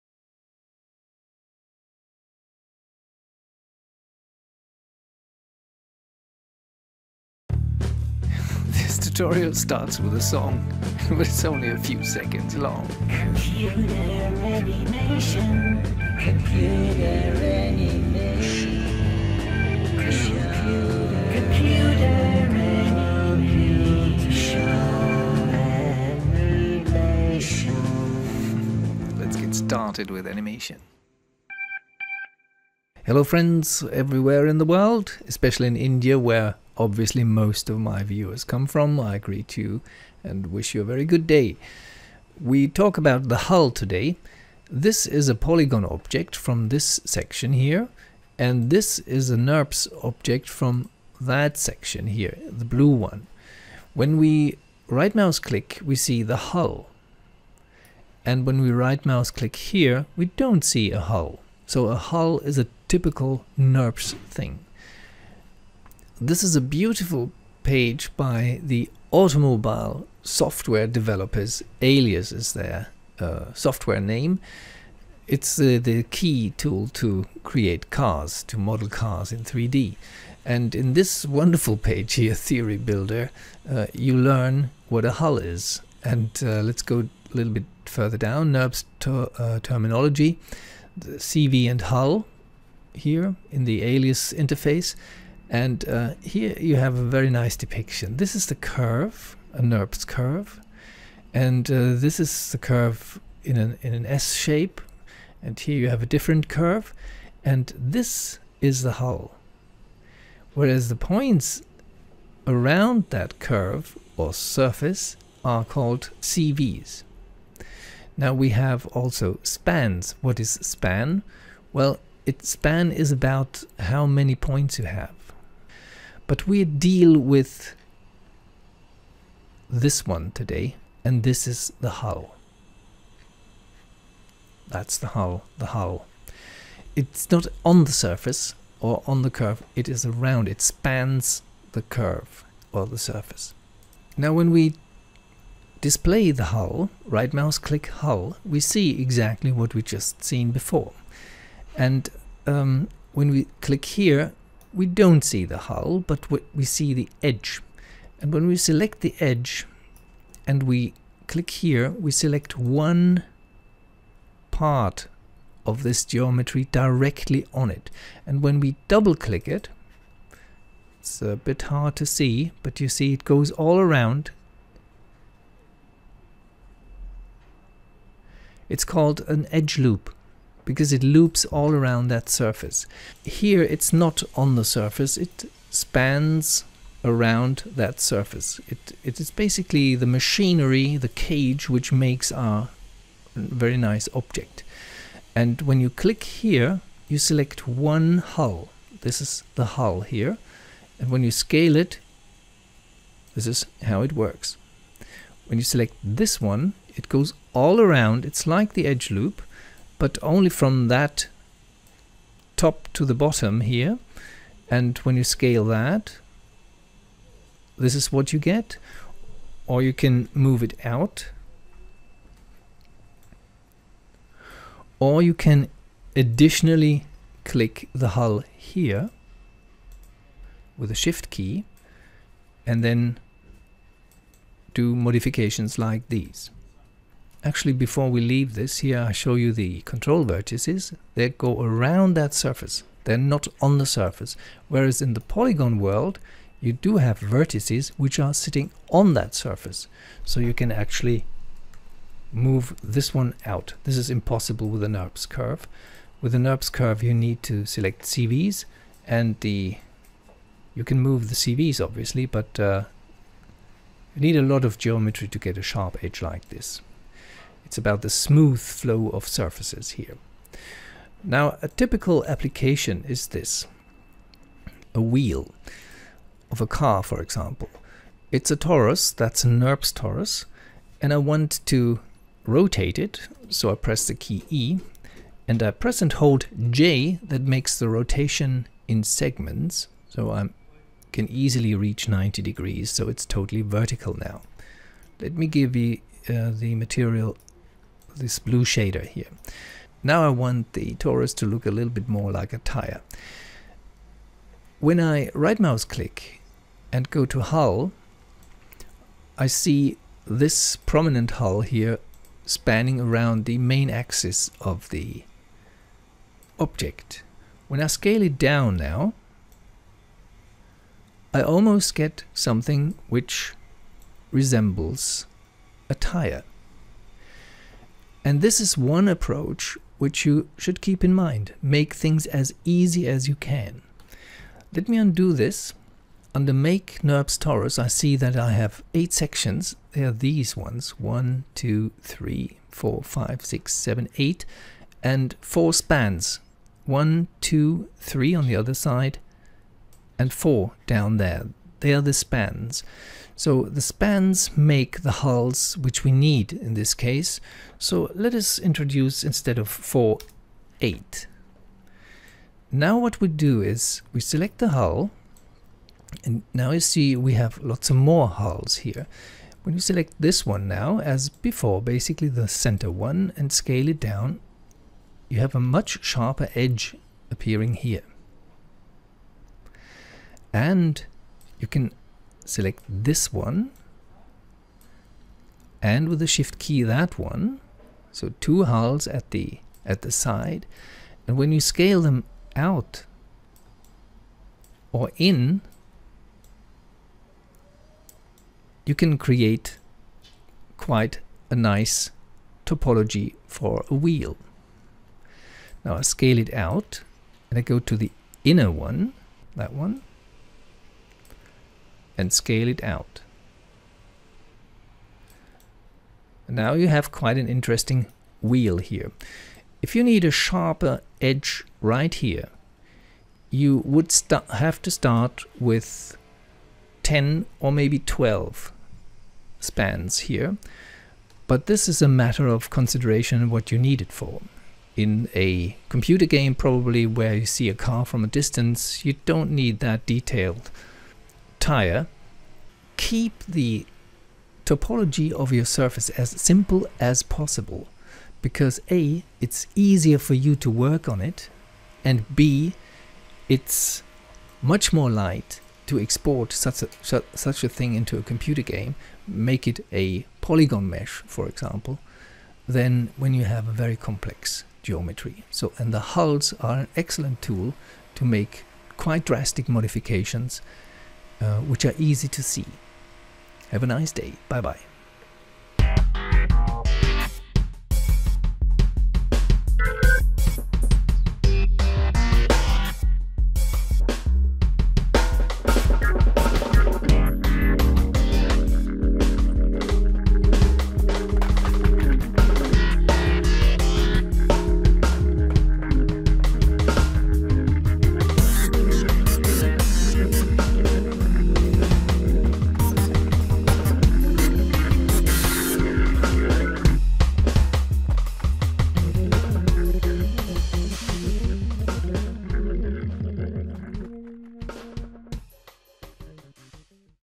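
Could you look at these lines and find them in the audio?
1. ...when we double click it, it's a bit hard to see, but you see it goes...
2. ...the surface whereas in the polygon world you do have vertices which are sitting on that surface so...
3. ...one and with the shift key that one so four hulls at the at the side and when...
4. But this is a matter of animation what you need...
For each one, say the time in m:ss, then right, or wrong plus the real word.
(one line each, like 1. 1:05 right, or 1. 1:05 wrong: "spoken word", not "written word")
1. 2:48 right
2. 4:03 right
3. 6:23 wrong: "two", not "four"
4. 7:11 wrong: "consideration", not "animation".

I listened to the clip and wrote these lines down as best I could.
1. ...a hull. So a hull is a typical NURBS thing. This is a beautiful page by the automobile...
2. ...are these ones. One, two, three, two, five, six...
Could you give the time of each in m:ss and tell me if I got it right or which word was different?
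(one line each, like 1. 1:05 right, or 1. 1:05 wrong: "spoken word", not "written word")
1. 1:00 right
2. 5:40 wrong: "four", not "two".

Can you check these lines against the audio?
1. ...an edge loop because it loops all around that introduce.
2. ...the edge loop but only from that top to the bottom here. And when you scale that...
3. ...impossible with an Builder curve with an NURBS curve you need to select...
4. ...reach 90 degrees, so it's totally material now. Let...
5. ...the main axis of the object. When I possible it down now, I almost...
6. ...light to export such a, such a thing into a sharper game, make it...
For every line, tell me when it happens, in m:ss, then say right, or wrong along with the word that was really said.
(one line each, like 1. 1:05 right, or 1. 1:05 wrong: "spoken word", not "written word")
1. 2:59 wrong: "surface", not "introduce"
2. 3:28 right
3. 4:14 wrong: "NURBS", not "Builder"
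4. 4:51 wrong: "vertical", not "material"
5. 5:13 wrong: "scale", not "possible"
6. 7:35 wrong: "computer", not "sharper".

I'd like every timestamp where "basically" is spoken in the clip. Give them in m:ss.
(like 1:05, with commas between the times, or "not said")
3:09, 6:11.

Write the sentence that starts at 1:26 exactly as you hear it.
And uh, let's go a little bit further down, NURBS uh, terminology, the CV and hull here in the alias interface.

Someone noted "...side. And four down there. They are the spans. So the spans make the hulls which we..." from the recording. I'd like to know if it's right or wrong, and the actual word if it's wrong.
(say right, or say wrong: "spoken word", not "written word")
right.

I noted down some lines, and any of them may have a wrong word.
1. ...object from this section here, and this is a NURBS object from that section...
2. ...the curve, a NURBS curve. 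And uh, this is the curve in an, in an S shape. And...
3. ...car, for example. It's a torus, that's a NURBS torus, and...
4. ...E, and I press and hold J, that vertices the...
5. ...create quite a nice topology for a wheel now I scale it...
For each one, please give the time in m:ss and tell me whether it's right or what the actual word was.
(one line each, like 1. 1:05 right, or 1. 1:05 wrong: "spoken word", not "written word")
1. 0:45 right
2. 1:38 right
3. 4:36 right
4. 4:44 wrong: "makes", not "vertices"
5. 6:39 right.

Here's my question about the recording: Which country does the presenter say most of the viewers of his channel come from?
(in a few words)
India.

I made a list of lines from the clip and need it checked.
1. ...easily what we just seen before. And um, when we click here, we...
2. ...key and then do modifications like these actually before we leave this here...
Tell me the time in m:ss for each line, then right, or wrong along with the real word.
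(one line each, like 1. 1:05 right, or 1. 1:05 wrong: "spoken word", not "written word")
1. 2:29 wrong: "exactly", not "easily"
2. 3:51 right.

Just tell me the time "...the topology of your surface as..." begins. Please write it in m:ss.
7:23.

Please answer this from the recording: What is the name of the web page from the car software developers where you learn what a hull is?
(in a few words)
Theory Builder.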